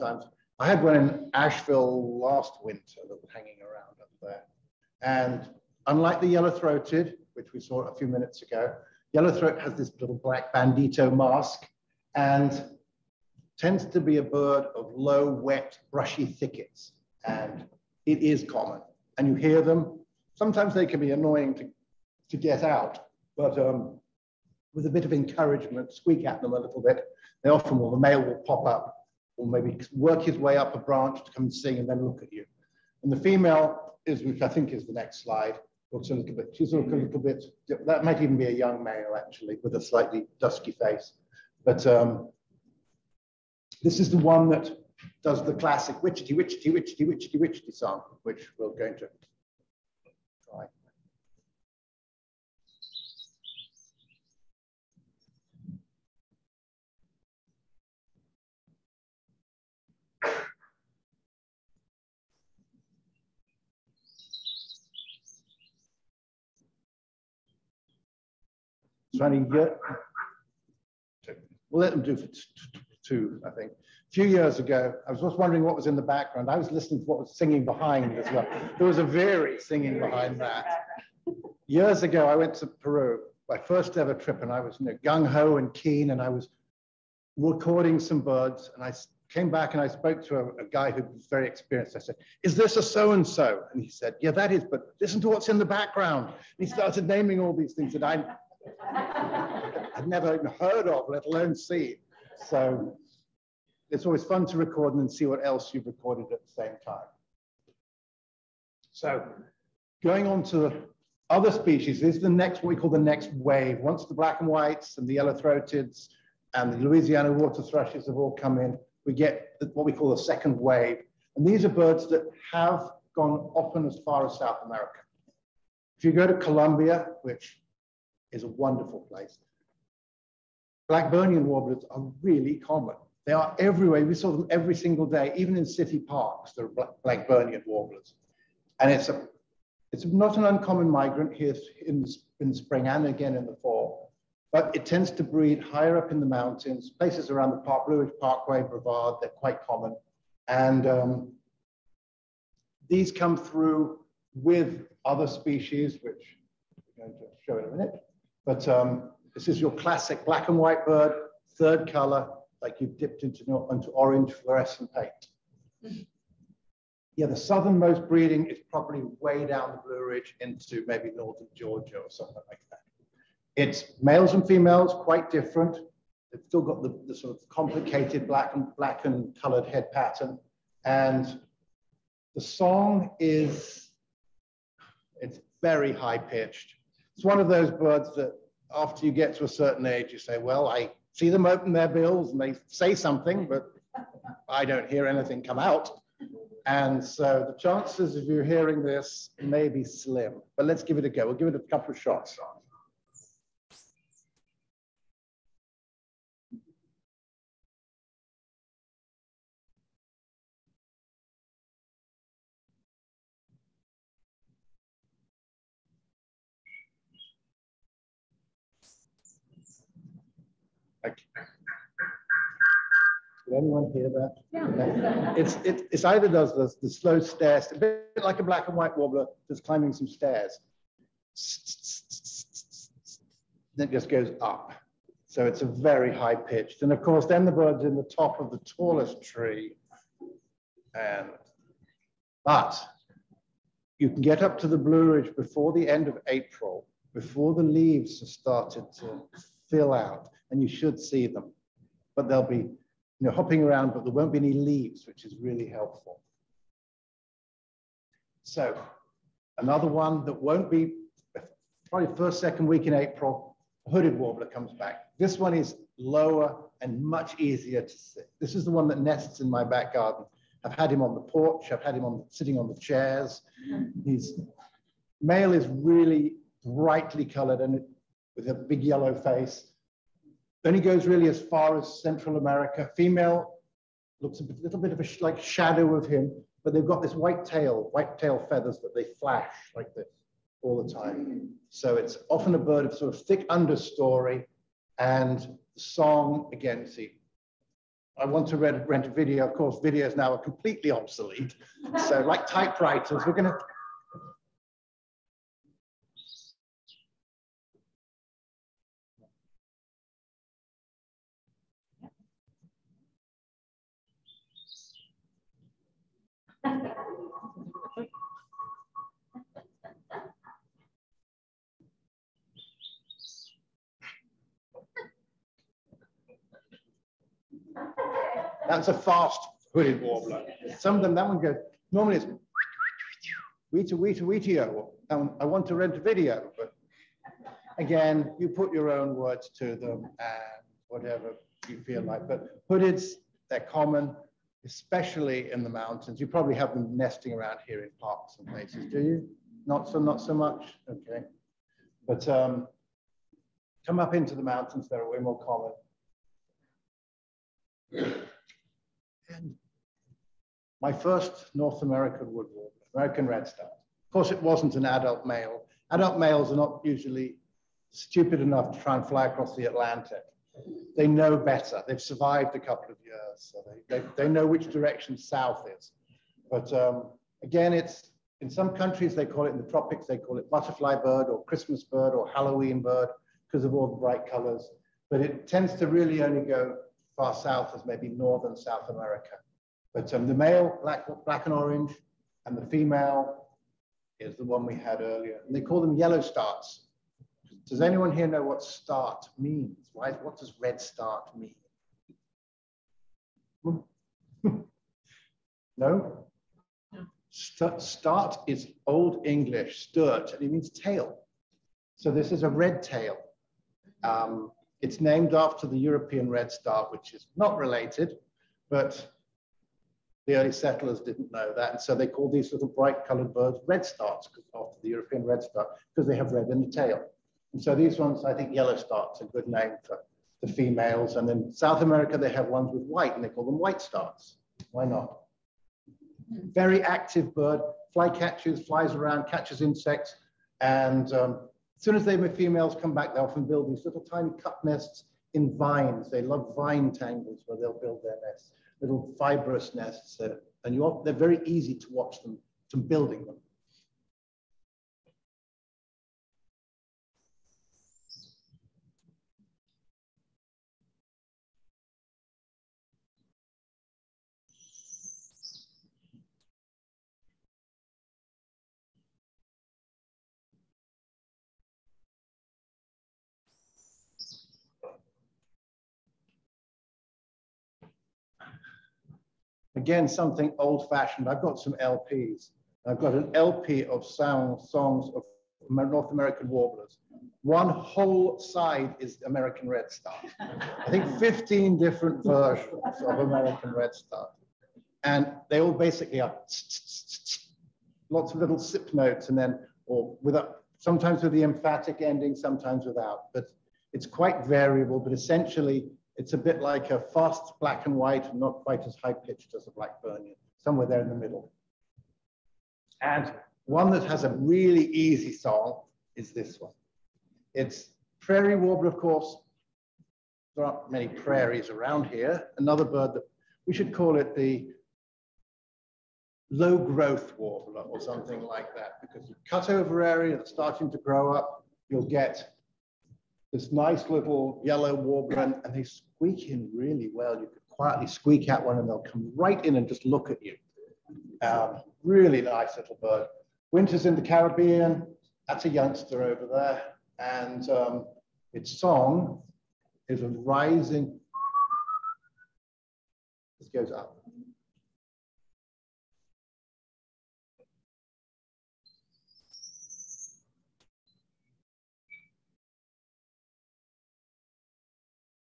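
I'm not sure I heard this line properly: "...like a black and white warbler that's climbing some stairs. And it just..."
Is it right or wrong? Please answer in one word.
right.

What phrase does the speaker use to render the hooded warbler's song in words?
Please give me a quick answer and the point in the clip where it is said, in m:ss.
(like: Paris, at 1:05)
I want to rent a video, at 5:35.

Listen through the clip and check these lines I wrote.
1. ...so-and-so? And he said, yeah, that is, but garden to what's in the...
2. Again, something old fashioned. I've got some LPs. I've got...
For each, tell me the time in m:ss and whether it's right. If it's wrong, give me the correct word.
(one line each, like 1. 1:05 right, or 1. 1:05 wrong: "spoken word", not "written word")
1. 1:32 wrong: "listen", not "garden"
2. 7:59 right.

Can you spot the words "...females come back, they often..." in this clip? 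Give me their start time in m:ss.
7:22.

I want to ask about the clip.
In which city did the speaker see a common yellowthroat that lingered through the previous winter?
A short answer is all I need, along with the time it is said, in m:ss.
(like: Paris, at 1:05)
Asheville, at 0:01.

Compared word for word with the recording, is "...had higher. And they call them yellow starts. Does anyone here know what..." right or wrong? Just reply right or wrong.
wrong.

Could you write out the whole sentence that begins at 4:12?
But they'll be you know, hopping around, but there won't be any leaves, which is really helpful.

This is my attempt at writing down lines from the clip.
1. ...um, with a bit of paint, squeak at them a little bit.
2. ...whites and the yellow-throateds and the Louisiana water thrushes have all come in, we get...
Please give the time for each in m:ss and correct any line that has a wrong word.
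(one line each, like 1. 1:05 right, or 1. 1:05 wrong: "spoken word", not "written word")
1. 0:23 wrong: "encouragement", not "paint"
2. 1:54 right.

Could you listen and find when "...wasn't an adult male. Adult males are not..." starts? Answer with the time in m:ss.
6:04.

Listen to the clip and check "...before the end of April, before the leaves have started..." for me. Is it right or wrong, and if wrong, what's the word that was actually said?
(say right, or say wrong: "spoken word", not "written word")
right.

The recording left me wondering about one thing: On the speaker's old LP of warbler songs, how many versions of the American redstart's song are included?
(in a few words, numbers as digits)
15.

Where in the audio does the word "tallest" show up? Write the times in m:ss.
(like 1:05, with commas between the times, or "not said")
3:58.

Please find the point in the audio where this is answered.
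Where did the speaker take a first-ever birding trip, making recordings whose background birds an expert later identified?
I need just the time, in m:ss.
1:22.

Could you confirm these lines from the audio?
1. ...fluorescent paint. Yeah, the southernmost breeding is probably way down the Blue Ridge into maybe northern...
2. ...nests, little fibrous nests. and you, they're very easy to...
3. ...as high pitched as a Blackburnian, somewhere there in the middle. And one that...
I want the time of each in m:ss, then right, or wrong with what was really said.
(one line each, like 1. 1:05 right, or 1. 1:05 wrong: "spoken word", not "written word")
1. 2:44 right
2. 7:28 right
3. 8:28 right.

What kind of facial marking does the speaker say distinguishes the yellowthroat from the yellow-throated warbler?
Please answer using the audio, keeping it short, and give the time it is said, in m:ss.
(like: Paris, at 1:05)
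black bandito mask, at 0:10.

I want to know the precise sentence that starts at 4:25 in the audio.
This one is lower and much easier to see.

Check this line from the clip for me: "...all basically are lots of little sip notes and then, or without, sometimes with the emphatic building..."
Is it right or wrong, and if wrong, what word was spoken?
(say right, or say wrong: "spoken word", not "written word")
wrong: "ending", not "building".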